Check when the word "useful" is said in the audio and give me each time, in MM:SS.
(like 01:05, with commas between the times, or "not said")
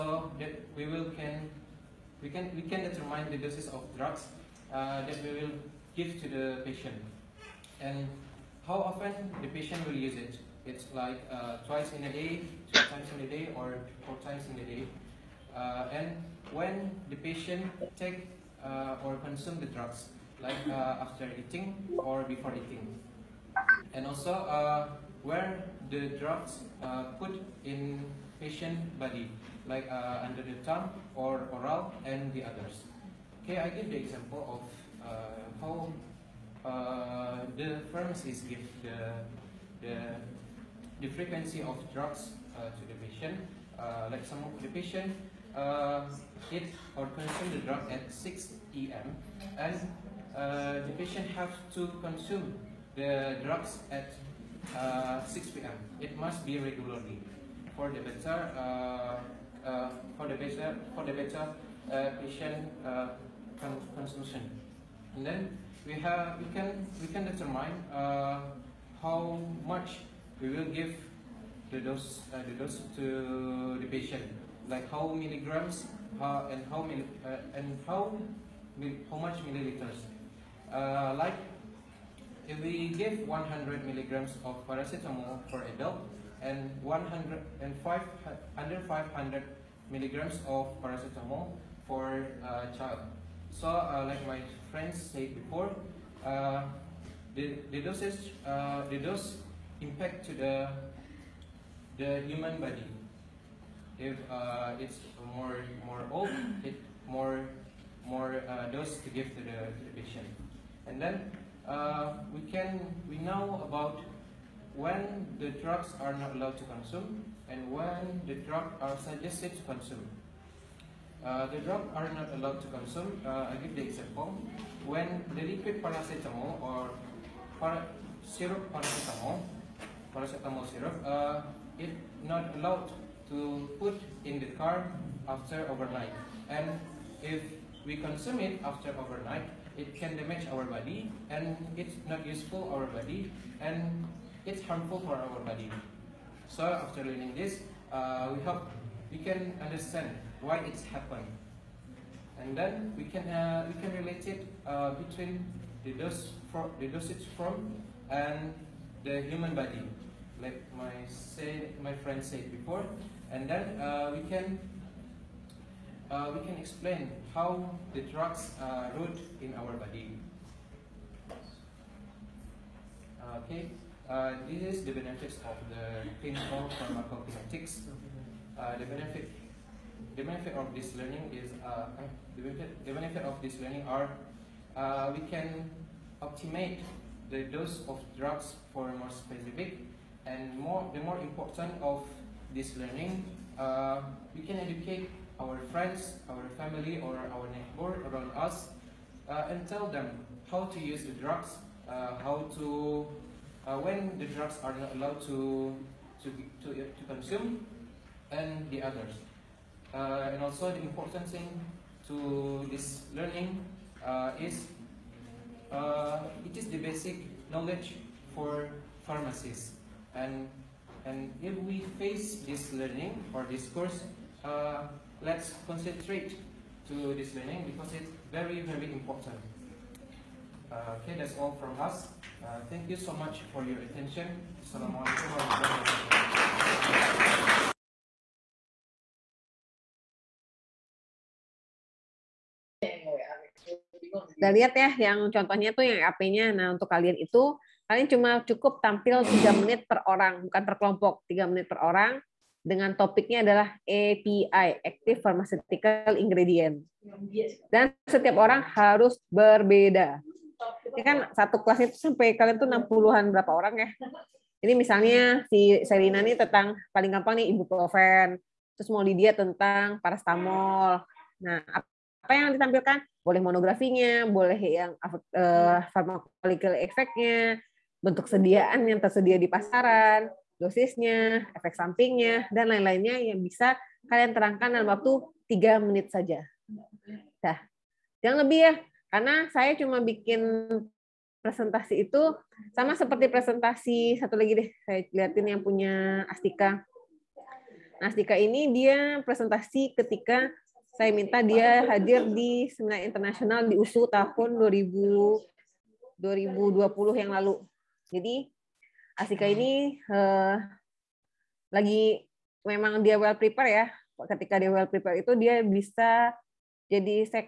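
02:22.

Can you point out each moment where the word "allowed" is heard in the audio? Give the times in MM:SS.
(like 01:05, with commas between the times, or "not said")
01:56, 02:02, 02:12, 03:24.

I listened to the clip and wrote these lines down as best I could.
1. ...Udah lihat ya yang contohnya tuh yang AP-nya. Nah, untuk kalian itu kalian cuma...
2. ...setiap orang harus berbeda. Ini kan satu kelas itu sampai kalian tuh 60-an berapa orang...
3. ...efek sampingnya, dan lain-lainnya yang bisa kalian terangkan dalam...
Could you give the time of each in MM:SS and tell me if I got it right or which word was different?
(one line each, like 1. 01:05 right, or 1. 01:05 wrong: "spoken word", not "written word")
1. 04:04 right
2. 04:18 right
3. 04:41 right.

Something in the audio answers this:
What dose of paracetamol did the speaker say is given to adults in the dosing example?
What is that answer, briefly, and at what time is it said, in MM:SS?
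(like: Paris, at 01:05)
100 milligrams, at 01:23.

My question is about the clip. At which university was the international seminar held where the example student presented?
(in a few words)
USU.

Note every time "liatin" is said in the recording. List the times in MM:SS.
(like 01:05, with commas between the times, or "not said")
04:55.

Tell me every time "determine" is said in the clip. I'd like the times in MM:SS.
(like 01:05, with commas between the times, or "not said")
00:02, 01:07.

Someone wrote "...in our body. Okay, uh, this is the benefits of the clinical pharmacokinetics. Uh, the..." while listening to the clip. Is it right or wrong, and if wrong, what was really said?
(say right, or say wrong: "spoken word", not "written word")
right.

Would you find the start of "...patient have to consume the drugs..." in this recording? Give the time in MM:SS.
00:50.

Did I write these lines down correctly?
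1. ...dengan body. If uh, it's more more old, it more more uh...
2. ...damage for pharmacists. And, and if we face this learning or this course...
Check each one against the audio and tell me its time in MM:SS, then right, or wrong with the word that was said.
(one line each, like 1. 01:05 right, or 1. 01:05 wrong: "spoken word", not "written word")
1. 01:42 wrong: "human", not "dengan"
2. 03:37 wrong: "knowledge", not "damage".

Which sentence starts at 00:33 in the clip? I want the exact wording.
Okay, I give the example of uh, how uh, the pharmacy give the, the, the frequency of drugs uh, to the patient.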